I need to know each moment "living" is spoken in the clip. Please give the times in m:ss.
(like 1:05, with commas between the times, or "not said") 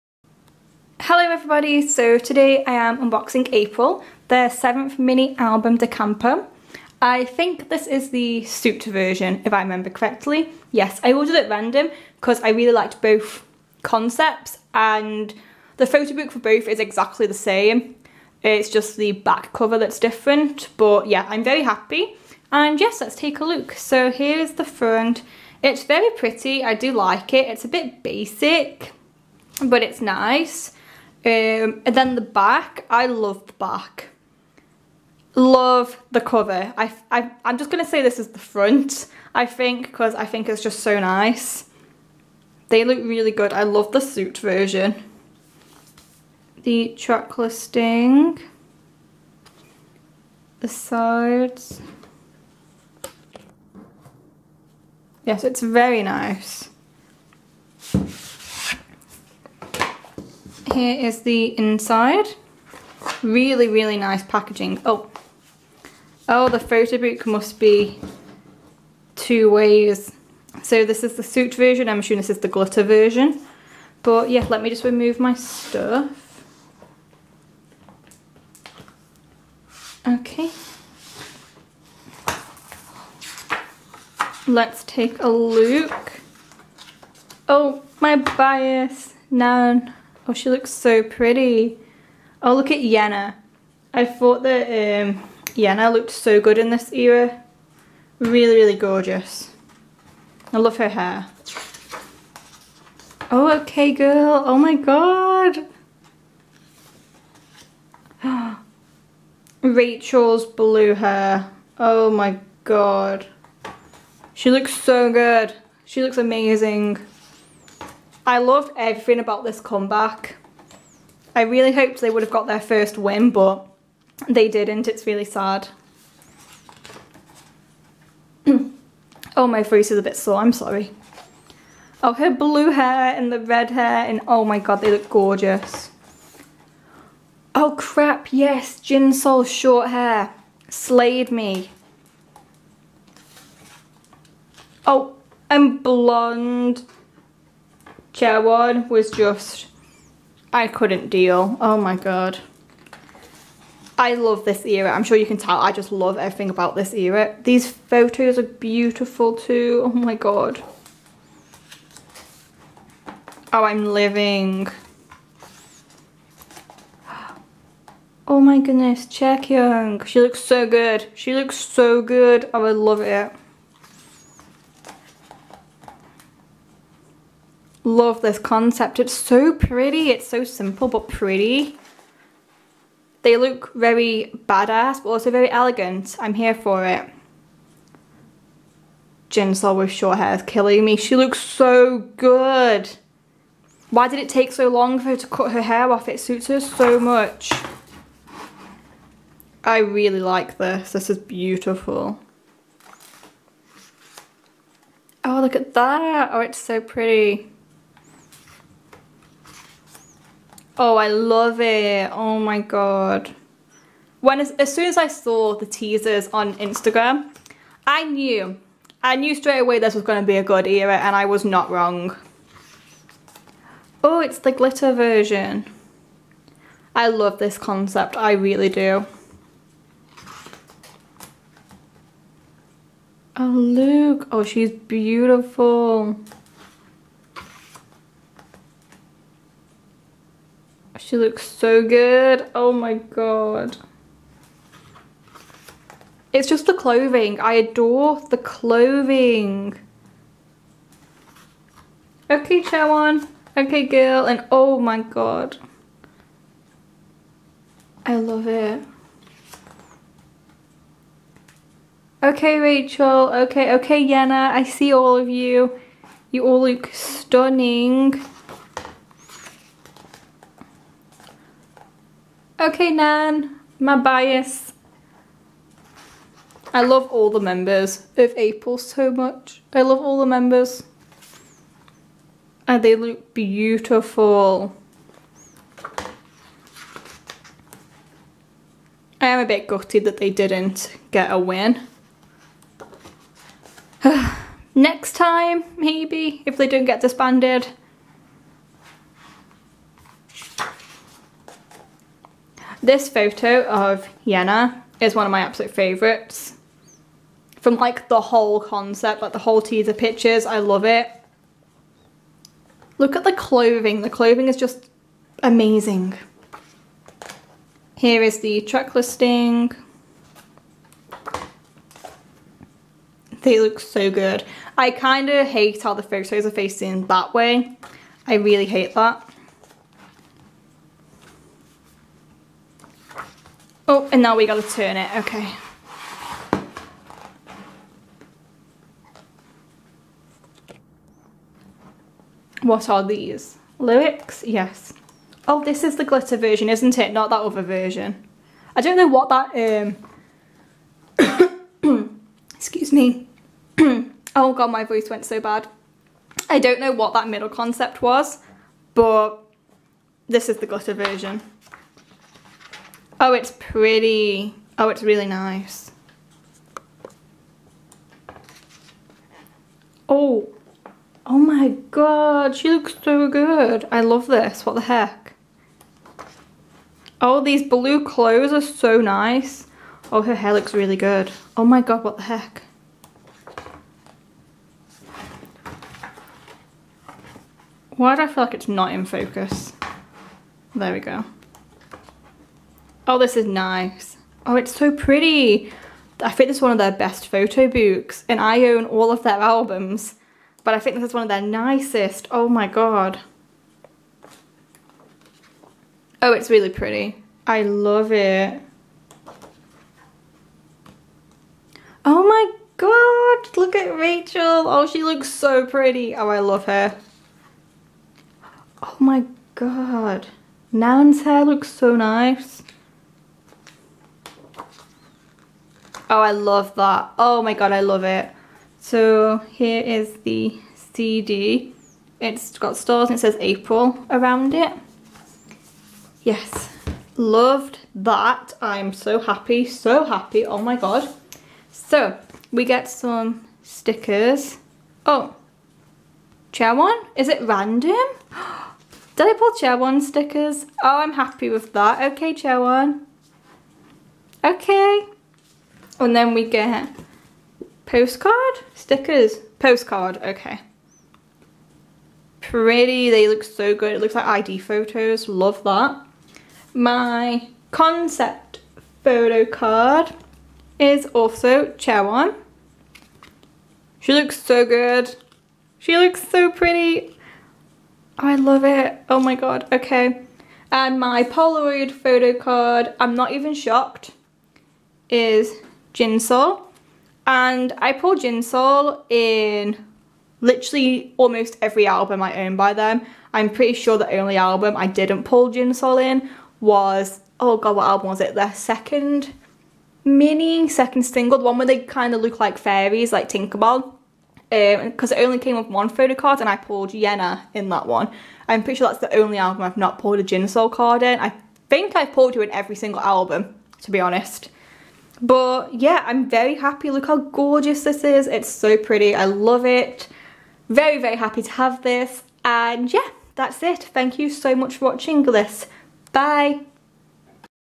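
2:43.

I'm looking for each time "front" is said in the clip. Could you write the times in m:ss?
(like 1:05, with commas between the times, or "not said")
0:24, 0:38.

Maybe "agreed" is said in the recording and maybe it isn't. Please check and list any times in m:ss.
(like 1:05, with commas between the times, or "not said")
not said.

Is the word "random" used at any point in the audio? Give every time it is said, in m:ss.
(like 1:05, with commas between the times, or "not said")
0:11, 7:27.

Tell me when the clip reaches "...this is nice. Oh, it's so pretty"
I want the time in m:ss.
6:33.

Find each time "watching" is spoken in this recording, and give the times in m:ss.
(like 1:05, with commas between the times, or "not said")
8:44.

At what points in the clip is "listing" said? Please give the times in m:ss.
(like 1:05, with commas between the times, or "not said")
0:47, 5:18.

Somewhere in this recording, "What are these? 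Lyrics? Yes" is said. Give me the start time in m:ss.
5:42.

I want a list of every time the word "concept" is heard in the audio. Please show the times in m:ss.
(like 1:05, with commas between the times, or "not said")
0:13, 2:58, 3:47, 5:08, 5:57, 7:47.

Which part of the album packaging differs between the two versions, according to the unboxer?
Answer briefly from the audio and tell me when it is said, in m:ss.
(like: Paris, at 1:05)
back cover, at 0:19.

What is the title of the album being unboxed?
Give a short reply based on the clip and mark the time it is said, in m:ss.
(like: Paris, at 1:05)
Da Capo, at 0:05.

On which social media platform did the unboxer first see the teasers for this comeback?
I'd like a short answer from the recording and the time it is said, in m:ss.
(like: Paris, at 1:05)
Instagram, at 3:36.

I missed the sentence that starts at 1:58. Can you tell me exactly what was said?
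I loved everything about this comeback.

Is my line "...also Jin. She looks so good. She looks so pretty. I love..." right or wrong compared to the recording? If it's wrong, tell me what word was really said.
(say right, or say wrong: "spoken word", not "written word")
wrong: "Chaewon", not "Jin".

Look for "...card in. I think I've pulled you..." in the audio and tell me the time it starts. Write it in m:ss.
8:30.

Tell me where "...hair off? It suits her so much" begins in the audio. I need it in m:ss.
3:15.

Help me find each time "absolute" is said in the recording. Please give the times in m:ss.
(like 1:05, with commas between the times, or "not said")
5:05.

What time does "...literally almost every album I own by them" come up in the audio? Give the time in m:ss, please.
8:10.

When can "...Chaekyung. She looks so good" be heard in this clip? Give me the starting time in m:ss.
2:49.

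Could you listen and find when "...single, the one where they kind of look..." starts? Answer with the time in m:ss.
8:21.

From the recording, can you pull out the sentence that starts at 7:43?
It looks like ID photos, love that.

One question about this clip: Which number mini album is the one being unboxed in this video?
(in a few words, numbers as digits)
7th.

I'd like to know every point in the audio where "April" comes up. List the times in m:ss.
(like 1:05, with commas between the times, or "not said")
0:03, 4:38, 7:13.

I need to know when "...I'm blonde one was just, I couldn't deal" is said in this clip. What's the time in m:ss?
2:25.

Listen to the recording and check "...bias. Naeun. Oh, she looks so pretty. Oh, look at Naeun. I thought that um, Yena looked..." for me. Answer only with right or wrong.
wrong.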